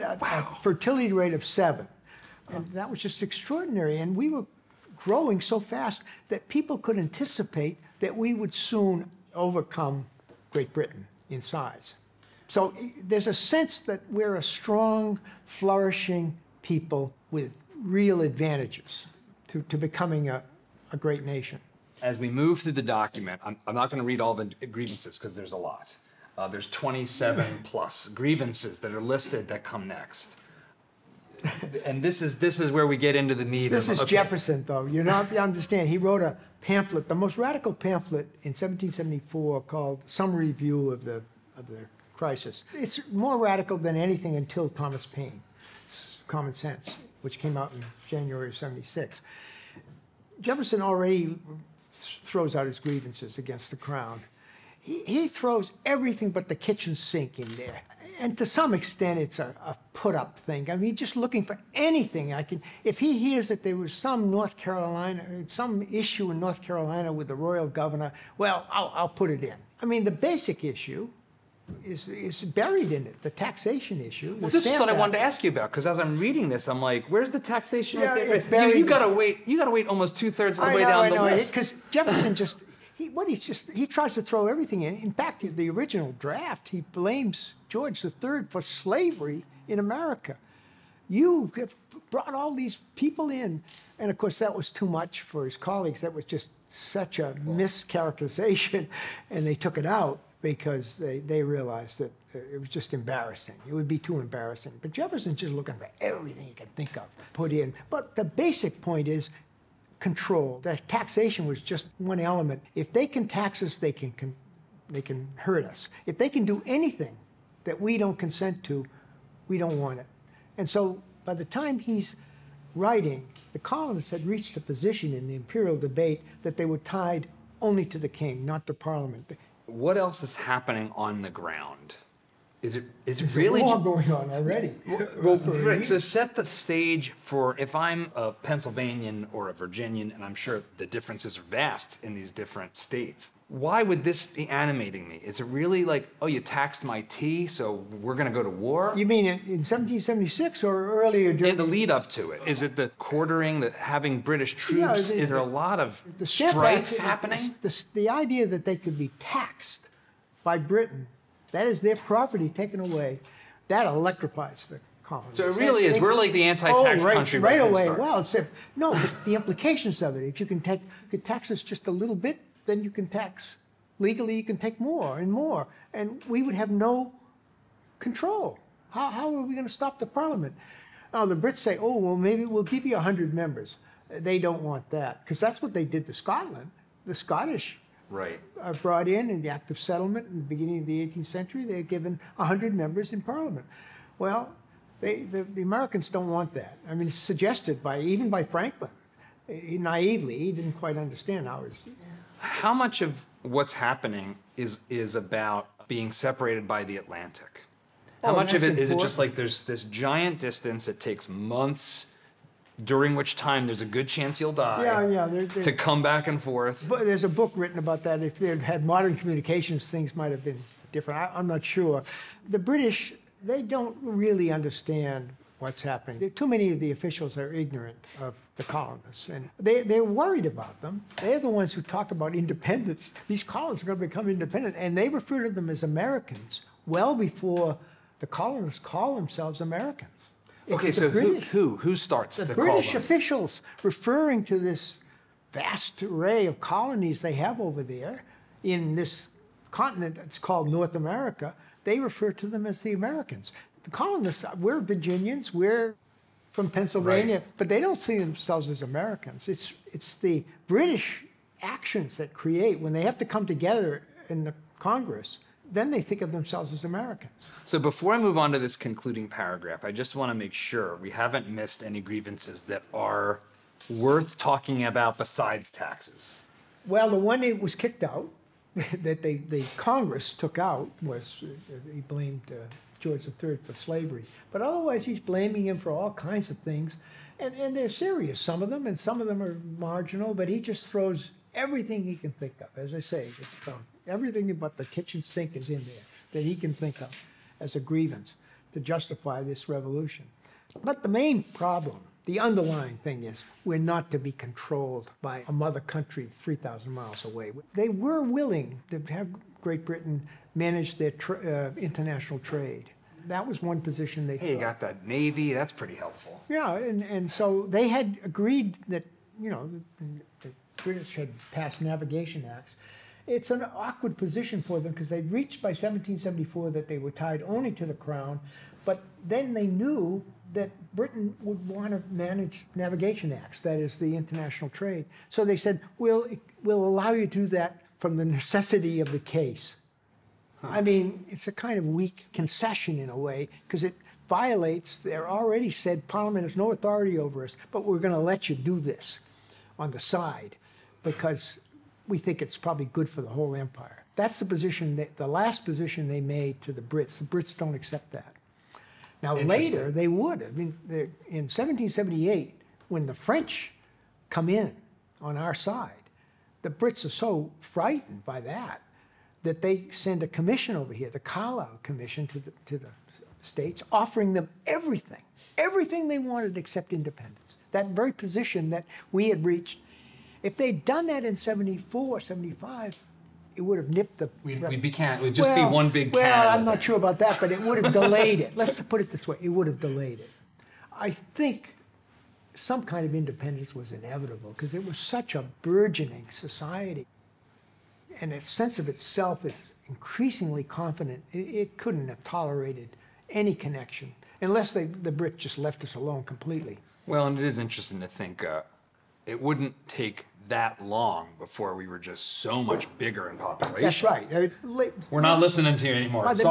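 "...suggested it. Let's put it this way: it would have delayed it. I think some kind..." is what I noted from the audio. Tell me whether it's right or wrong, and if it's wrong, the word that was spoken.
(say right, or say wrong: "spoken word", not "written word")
wrong: "delayed", not "suggested".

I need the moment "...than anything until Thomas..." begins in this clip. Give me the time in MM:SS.
00:43.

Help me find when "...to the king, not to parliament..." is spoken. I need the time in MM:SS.
02:07.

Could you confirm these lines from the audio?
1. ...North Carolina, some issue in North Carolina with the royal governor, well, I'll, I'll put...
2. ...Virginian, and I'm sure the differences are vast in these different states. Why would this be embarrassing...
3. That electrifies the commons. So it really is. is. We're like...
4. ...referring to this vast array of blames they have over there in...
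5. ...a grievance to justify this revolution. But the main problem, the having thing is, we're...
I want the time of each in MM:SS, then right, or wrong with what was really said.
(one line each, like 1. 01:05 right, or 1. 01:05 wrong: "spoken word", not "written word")
1. 01:04 right
2. 02:19 wrong: "animating", not "embarrassing"
3. 02:43 right
4. 04:03 wrong: "colonies", not "blames"
5. 04:57 wrong: "underlying", not "having".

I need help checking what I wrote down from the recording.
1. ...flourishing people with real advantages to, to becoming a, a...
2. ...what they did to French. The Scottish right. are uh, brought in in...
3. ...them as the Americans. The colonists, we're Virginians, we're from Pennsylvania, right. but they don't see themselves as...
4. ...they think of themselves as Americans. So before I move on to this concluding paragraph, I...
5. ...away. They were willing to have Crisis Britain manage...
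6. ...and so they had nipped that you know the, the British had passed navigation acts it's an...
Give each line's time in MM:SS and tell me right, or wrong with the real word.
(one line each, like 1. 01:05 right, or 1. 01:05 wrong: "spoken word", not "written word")
1. 00:15 right
2. 03:05 wrong: "Scotland", not "French"
3. 04:12 right
4. 04:25 right
5. 05:07 wrong: "Great", not "Crisis"
6. 05:17 wrong: "agreed", not "nipped".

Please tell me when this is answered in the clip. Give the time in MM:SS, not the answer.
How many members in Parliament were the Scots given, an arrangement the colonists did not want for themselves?
03:12.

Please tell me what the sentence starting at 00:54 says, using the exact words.
He, he throws everything but the kitchen sink in there.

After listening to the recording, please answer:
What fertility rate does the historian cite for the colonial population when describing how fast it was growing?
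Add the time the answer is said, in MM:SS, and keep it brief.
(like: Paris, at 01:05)
7, at 00:01.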